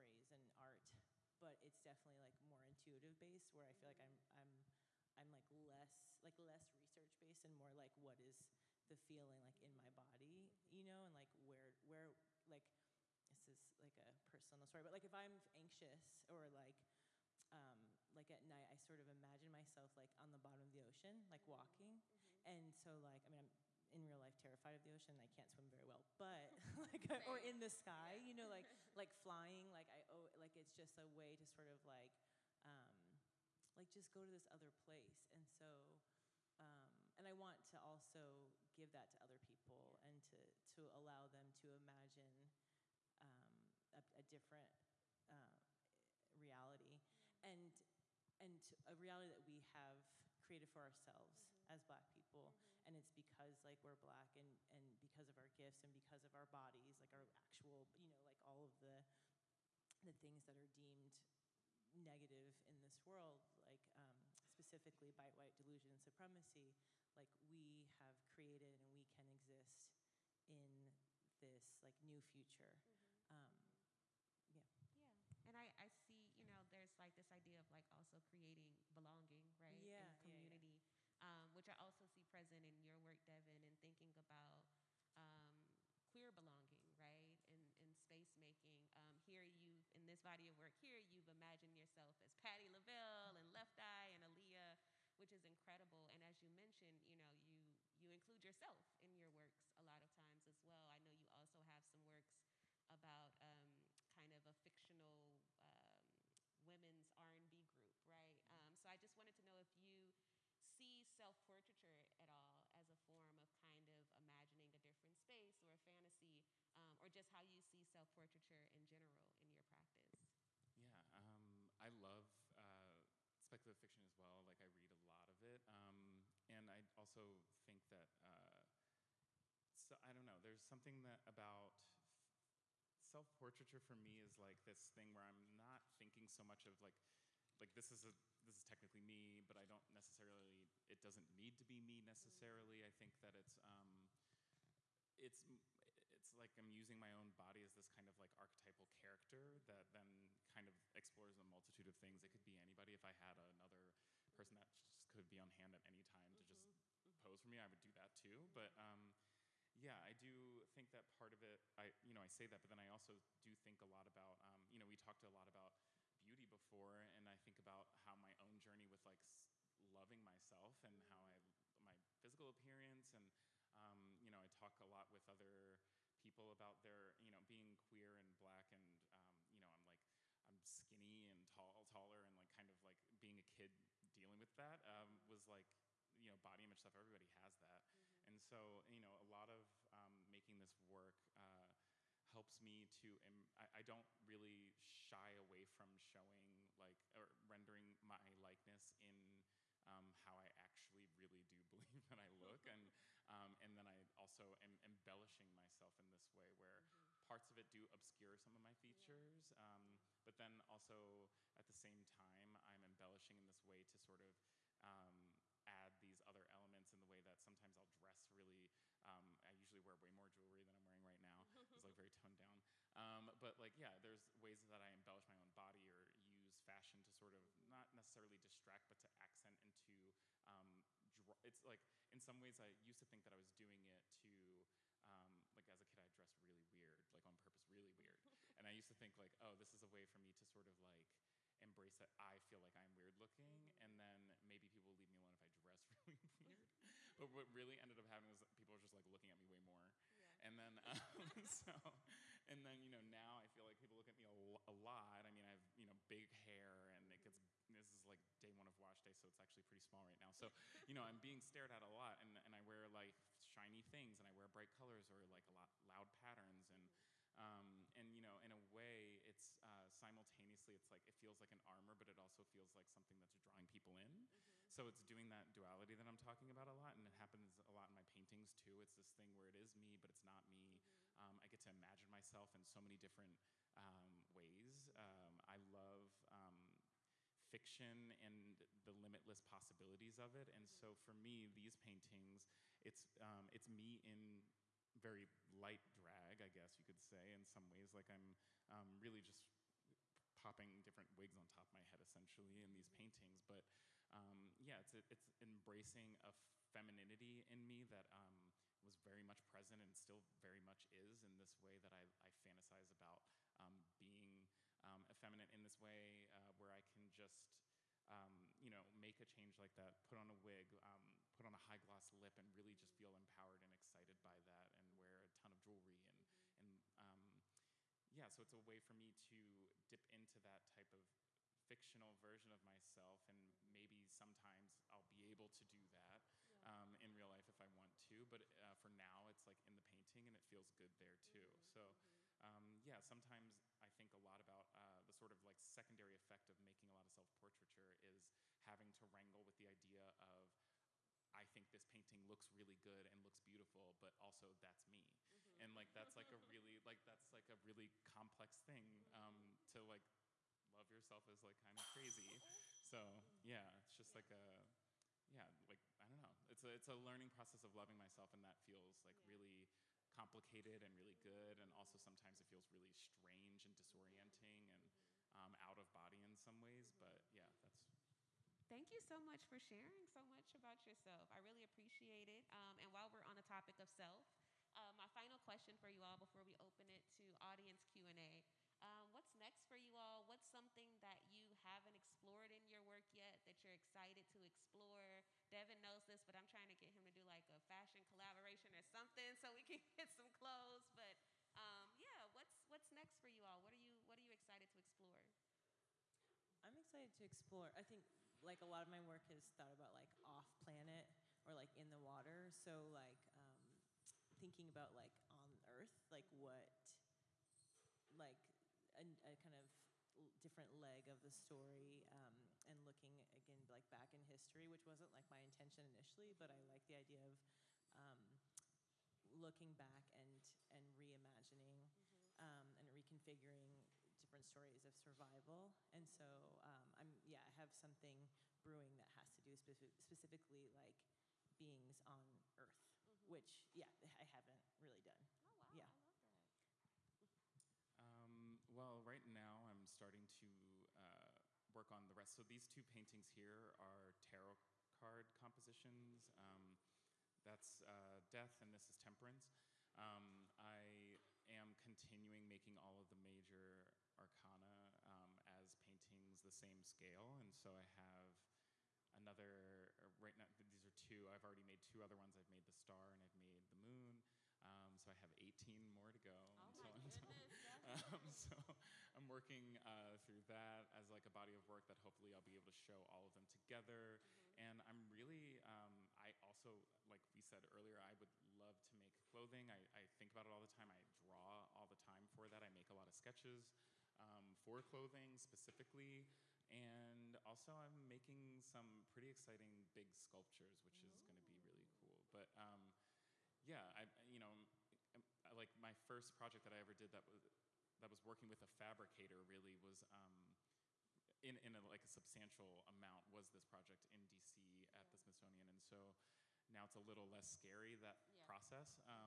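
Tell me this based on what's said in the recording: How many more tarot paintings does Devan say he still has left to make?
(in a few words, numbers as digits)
18.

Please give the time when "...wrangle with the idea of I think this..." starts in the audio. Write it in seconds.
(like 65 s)
349 s.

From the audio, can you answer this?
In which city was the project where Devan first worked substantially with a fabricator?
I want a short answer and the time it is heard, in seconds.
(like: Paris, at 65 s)
D.C., at 514 s.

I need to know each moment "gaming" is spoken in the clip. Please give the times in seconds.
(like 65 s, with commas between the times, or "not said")
not said.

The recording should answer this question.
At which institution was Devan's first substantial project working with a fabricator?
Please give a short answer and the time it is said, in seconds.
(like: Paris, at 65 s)
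the Smithsonian, at 515 s.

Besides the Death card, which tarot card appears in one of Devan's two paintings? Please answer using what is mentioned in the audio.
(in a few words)
Temperance.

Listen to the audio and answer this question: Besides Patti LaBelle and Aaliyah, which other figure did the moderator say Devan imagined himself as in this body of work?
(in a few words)
Left Eye.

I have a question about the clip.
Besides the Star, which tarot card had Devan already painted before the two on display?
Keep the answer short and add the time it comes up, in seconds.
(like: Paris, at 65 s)
the moon, at 473 s.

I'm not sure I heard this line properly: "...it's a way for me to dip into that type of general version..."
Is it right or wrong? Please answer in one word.
wrong.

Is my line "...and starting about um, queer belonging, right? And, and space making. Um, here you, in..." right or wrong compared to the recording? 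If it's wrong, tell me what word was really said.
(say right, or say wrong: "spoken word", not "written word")
wrong: "thinking", not "starting".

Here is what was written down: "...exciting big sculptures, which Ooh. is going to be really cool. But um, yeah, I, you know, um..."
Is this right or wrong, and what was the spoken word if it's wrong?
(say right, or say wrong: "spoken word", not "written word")
right.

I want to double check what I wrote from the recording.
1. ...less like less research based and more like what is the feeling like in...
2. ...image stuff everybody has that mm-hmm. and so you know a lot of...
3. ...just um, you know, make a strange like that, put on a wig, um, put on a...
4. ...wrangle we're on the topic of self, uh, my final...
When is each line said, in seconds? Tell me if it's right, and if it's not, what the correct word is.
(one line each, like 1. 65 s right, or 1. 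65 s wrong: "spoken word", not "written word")
1. 5 s right
2. 186 s right
3. 317 s wrong: "change", not "strange"
4. 382 s wrong: "while", not "wrangle".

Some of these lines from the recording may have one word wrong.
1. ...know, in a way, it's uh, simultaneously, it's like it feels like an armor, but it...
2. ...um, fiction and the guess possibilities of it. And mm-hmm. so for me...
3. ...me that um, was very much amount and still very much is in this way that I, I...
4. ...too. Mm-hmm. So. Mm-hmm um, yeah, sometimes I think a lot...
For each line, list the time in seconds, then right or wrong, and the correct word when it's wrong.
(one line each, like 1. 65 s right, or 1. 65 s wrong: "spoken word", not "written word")
1. 268 s right
2. 286 s wrong: "limitless", not "guess"
3. 307 s wrong: "present", not "amount"
4. 341 s right.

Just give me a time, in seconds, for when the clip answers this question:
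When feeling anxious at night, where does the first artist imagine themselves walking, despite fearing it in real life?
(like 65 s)
20 s.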